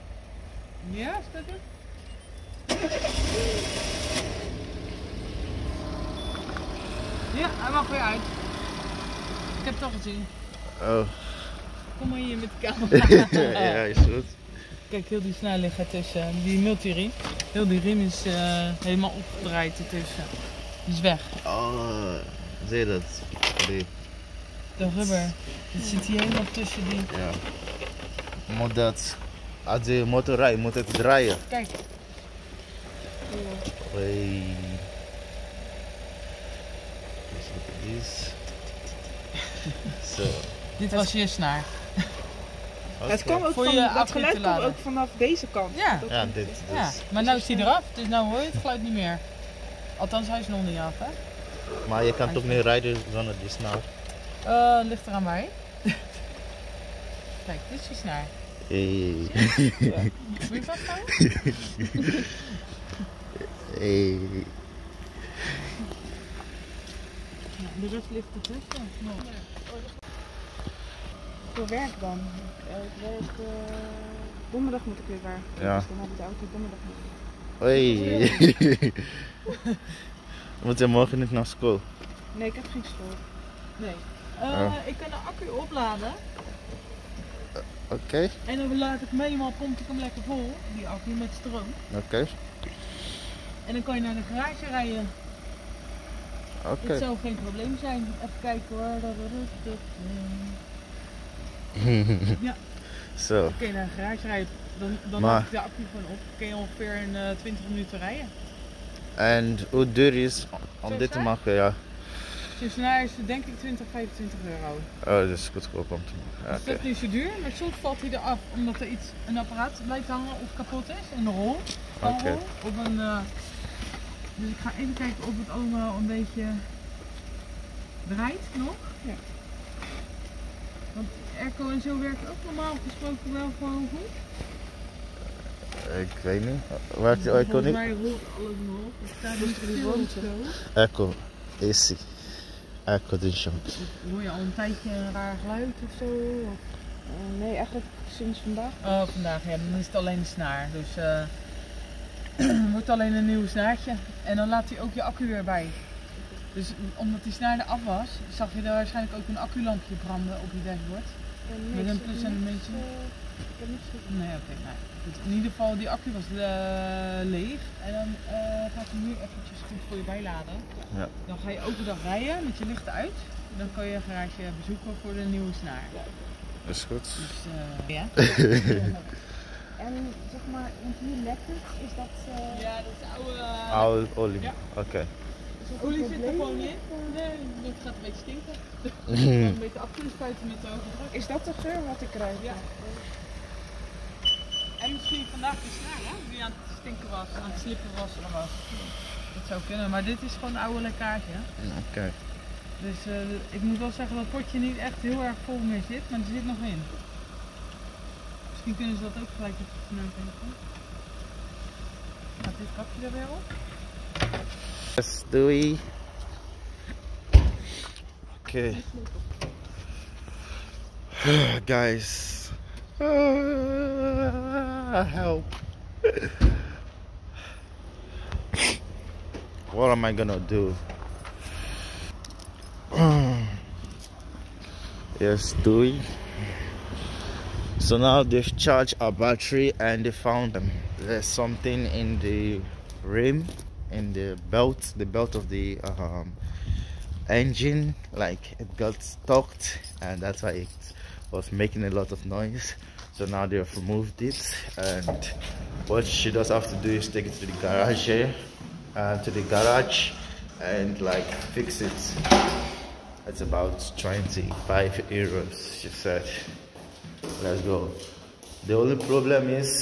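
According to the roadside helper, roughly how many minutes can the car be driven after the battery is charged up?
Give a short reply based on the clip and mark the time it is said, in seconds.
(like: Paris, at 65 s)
20 minutes, at 107 s.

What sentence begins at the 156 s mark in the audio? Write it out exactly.
Dus omdat die snaar er af was, zag je daar waarschijnlijk ook een acculampje branden op je dashboard.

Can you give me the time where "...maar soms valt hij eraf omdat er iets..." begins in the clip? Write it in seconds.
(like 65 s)
117 s.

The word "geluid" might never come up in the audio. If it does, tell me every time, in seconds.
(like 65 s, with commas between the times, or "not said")
44 s, 48 s, 145 s.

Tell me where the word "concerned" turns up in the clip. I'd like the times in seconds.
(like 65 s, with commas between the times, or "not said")
not said.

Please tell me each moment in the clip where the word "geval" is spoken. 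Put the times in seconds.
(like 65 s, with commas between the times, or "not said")
165 s.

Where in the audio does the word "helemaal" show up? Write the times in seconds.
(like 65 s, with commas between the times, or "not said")
18 s, 26 s.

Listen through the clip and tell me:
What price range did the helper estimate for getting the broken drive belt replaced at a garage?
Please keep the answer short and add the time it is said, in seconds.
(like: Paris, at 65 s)
20 to 25 euros, at 113 s.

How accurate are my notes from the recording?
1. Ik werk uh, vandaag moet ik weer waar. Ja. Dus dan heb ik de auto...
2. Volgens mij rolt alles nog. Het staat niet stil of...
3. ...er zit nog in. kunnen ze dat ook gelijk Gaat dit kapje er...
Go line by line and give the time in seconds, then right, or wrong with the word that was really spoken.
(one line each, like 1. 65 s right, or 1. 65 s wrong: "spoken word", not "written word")
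1. 72 s wrong: "donderdag", not "vandaag"
2. 137 s right
3. 206 s right.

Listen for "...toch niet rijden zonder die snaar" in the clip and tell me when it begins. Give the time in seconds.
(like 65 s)
52 s.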